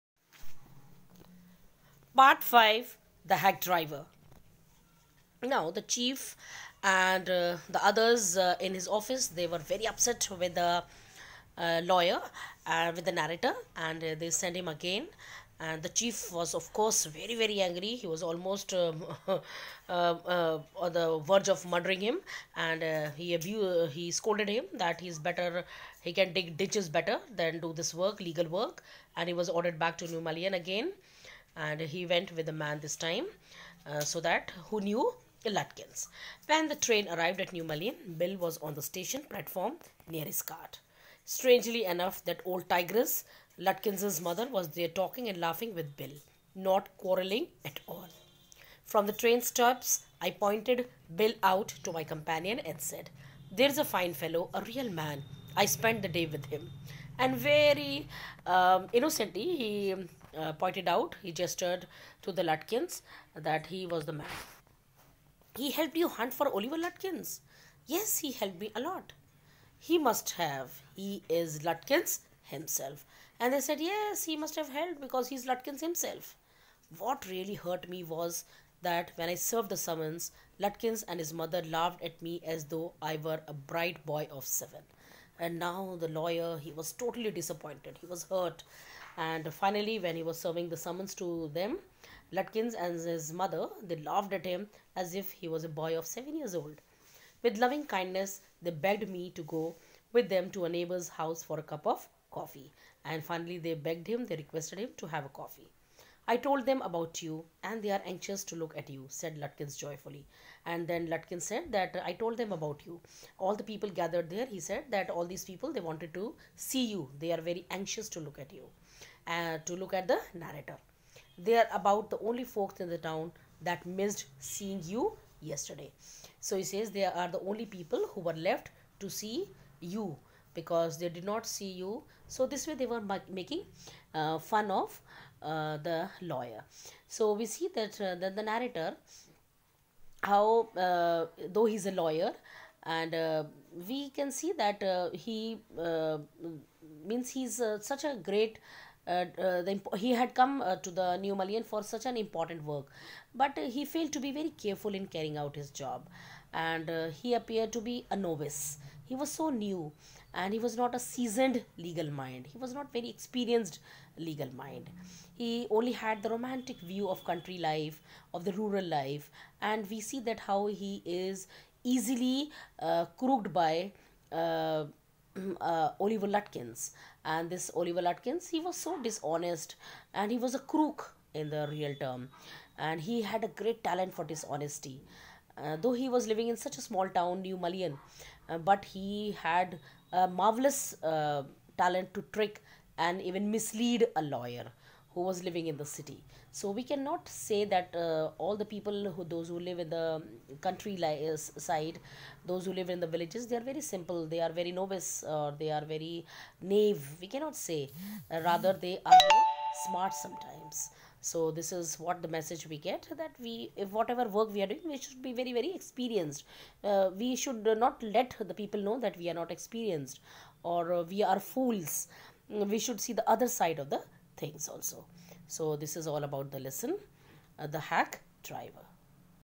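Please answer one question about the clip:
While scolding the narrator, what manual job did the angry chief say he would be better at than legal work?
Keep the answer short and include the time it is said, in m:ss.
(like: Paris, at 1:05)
dig ditches, at 0:26.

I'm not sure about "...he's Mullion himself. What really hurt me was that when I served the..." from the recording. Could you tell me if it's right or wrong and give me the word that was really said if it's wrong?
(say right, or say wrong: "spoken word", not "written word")
wrong: "Lutkins", not "Mullion".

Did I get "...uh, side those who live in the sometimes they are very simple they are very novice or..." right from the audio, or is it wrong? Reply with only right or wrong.
wrong.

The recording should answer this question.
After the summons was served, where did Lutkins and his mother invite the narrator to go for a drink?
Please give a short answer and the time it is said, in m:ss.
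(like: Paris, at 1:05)
a neighbor's house, at 1:40.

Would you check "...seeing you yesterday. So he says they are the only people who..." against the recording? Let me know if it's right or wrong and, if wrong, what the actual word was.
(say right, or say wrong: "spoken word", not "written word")
right.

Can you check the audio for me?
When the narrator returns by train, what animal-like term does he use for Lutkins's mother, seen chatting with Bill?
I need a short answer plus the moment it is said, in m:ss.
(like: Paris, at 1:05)
old tigress, at 0:42.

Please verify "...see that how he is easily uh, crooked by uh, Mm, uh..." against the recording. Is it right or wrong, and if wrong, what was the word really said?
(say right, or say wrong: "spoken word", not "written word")
right.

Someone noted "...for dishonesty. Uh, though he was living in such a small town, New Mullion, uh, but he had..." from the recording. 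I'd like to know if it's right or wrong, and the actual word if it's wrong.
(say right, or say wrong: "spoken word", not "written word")
right.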